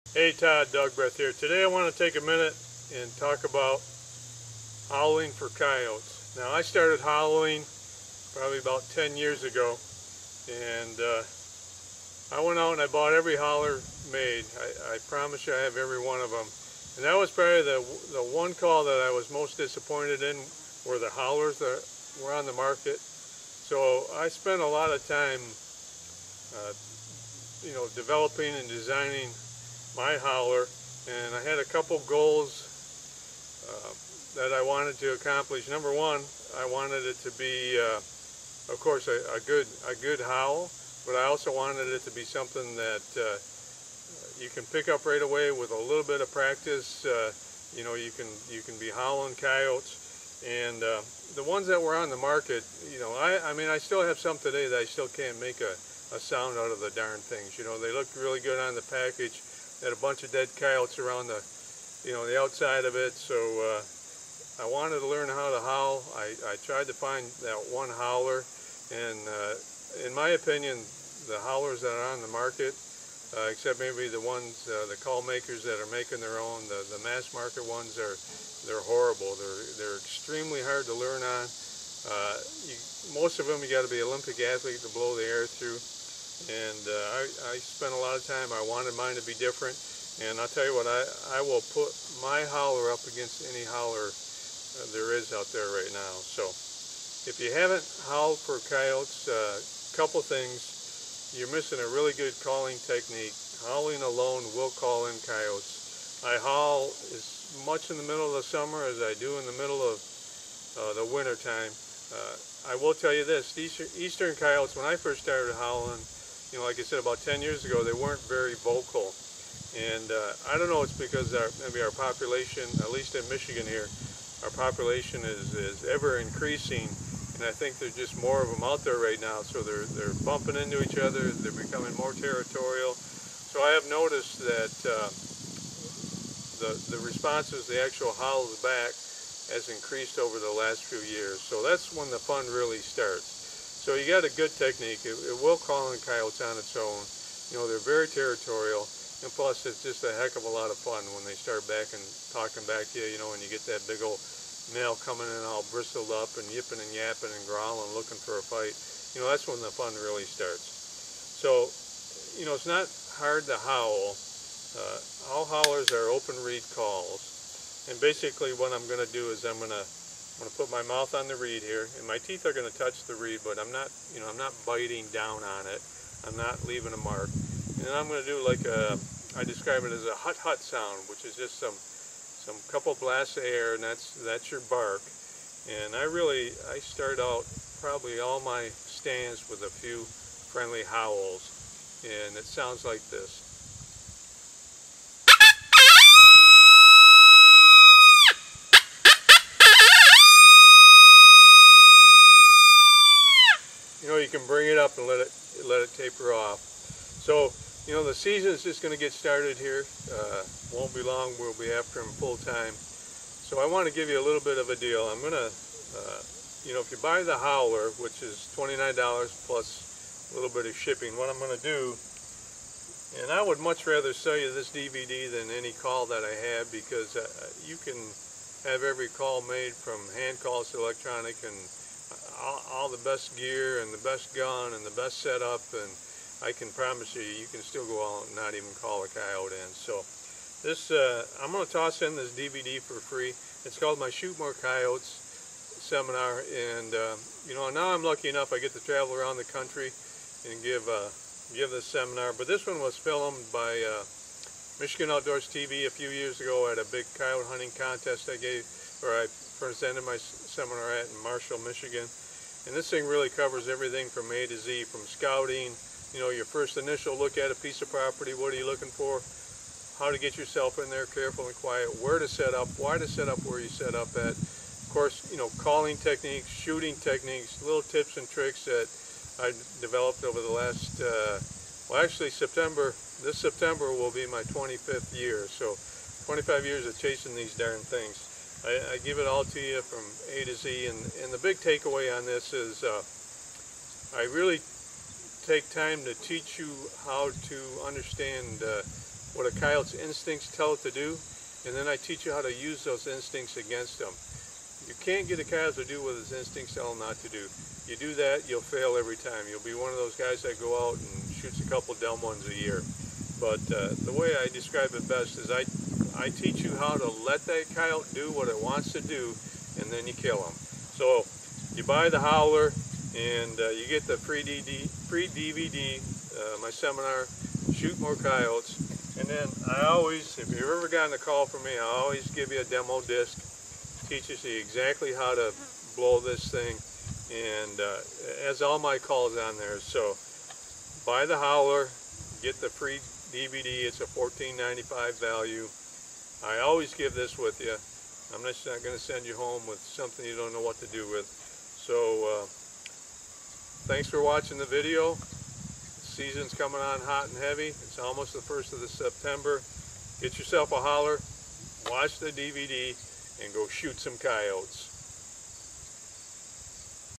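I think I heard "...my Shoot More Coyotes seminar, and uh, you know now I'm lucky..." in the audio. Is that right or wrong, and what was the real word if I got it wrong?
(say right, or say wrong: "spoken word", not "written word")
right.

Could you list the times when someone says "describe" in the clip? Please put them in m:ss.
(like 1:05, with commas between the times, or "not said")
2:59, 5:14.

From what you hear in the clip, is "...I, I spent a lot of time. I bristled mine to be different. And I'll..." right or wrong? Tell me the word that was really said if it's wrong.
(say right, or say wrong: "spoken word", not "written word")
wrong: "wanted", not "bristled".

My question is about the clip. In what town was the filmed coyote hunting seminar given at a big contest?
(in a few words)
Marshall, Michigan.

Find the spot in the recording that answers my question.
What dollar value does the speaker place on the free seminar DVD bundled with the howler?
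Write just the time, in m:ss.
5:44.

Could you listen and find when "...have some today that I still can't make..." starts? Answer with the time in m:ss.
0:54.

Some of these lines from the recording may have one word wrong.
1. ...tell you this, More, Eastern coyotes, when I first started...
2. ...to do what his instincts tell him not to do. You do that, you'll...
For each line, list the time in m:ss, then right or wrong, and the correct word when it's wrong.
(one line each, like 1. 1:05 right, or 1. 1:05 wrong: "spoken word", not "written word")
1. 1:52 wrong: "Eastern", not "More"
2. 5:05 right.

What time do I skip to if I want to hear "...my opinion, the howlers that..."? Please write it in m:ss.
1:10.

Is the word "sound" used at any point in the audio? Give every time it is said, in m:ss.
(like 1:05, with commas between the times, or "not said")
0:56, 3:00, 3:12.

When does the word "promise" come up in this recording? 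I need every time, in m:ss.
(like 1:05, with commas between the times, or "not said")
0:15, 3:56.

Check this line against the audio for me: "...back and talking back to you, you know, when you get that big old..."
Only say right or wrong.
right.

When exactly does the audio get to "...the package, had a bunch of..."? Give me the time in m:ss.
0:58.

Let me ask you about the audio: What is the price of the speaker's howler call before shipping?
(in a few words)
$29.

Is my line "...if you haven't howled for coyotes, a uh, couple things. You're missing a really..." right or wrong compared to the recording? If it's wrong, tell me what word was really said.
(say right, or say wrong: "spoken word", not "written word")
right.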